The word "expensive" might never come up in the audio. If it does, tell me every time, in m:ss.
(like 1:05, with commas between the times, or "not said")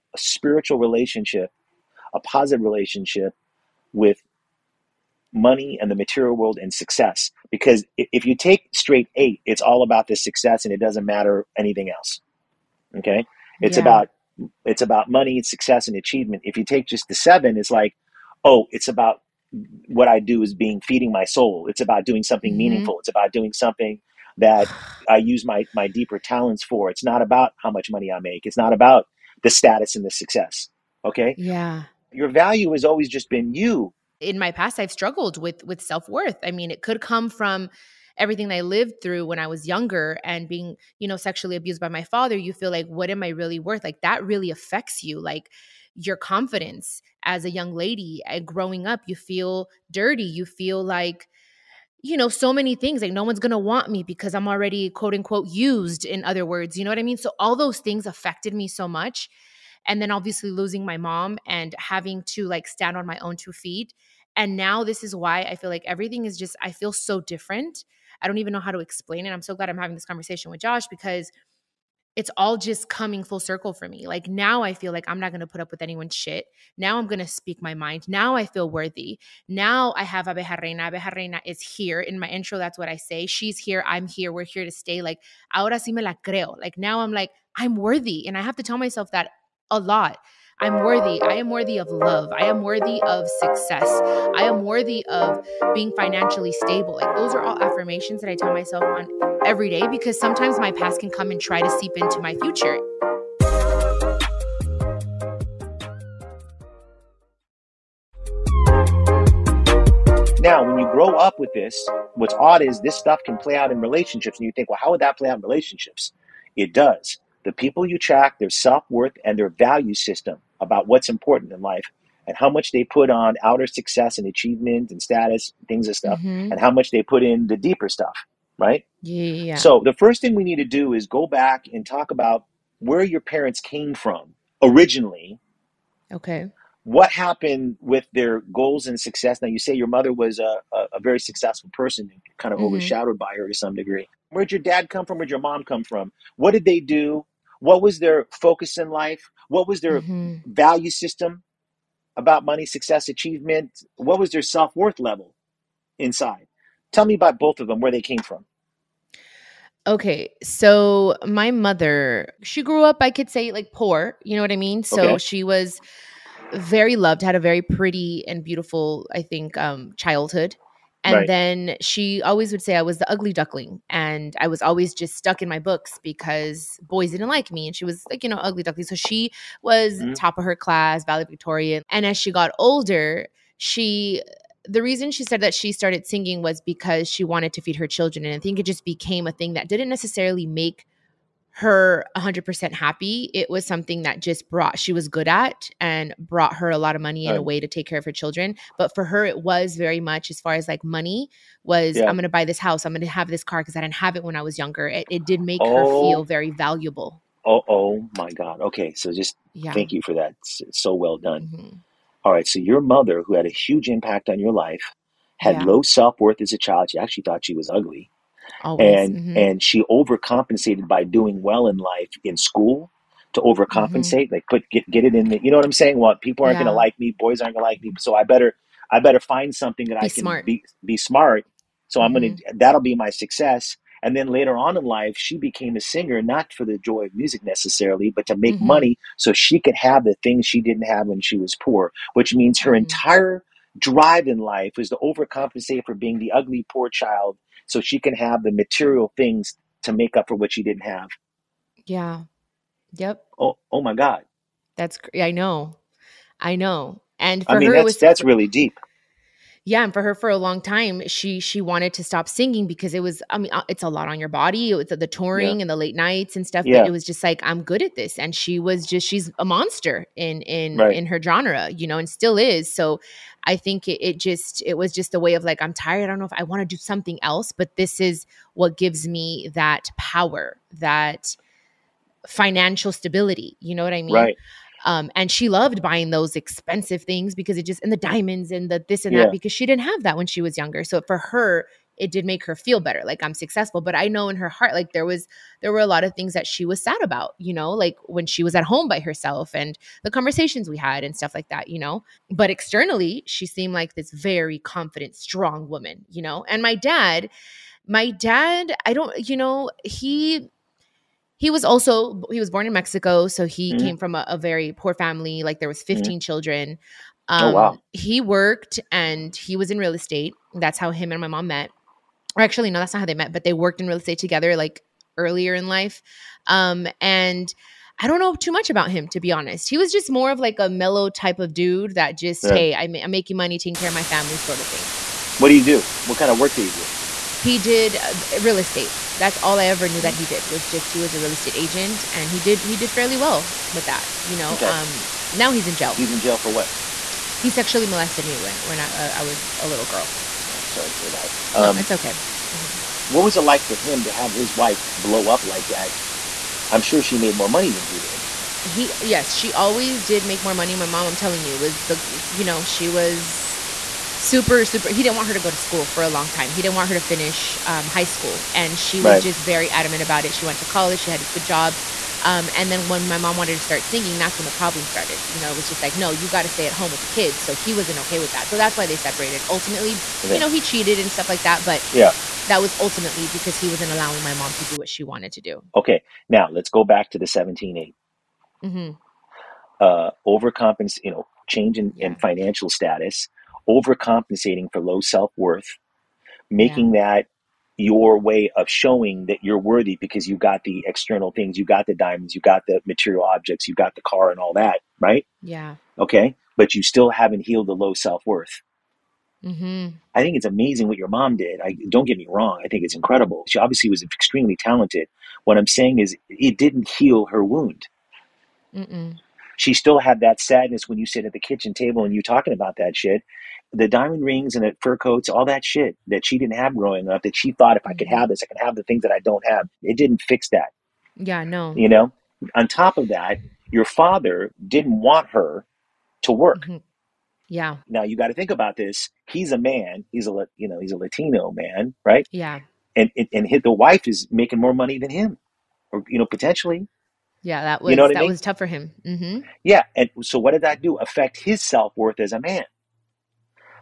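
4:46.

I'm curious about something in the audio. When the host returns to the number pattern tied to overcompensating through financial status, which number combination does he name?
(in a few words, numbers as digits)
17-8.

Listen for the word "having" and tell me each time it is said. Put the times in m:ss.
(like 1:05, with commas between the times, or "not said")
1:01, 1:09.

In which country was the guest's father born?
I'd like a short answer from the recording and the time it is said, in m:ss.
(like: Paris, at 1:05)
Mexico, at 5:12.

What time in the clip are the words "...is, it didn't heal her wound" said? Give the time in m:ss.
6:55.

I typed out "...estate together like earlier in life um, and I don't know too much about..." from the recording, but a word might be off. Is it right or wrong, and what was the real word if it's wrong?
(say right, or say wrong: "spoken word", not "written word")
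right.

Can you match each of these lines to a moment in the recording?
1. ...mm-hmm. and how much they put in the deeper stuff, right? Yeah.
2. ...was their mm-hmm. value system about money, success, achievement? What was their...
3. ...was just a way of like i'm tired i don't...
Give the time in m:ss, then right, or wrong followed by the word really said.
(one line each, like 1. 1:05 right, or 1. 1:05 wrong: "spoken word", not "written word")
1. 2:06 right
2. 2:29 right
3. 4:34 right.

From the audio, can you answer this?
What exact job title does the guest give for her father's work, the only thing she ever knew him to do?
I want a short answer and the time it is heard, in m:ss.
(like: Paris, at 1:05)
Real estate agent, at 5:41.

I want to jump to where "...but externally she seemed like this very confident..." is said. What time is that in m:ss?
5:02.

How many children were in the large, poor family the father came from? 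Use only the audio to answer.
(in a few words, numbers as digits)
15.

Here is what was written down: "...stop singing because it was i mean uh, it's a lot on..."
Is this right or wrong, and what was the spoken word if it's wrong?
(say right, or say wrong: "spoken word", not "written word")
right.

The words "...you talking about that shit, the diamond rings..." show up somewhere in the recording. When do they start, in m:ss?
7:02.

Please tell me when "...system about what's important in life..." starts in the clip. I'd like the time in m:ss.
1:59.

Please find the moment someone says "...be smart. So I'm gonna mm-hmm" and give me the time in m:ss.
3:50.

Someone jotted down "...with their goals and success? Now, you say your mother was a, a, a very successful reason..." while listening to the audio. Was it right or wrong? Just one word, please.
wrong.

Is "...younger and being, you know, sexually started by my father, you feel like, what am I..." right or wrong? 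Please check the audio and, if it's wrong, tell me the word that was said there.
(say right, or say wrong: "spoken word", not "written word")
wrong: "abused", not "started".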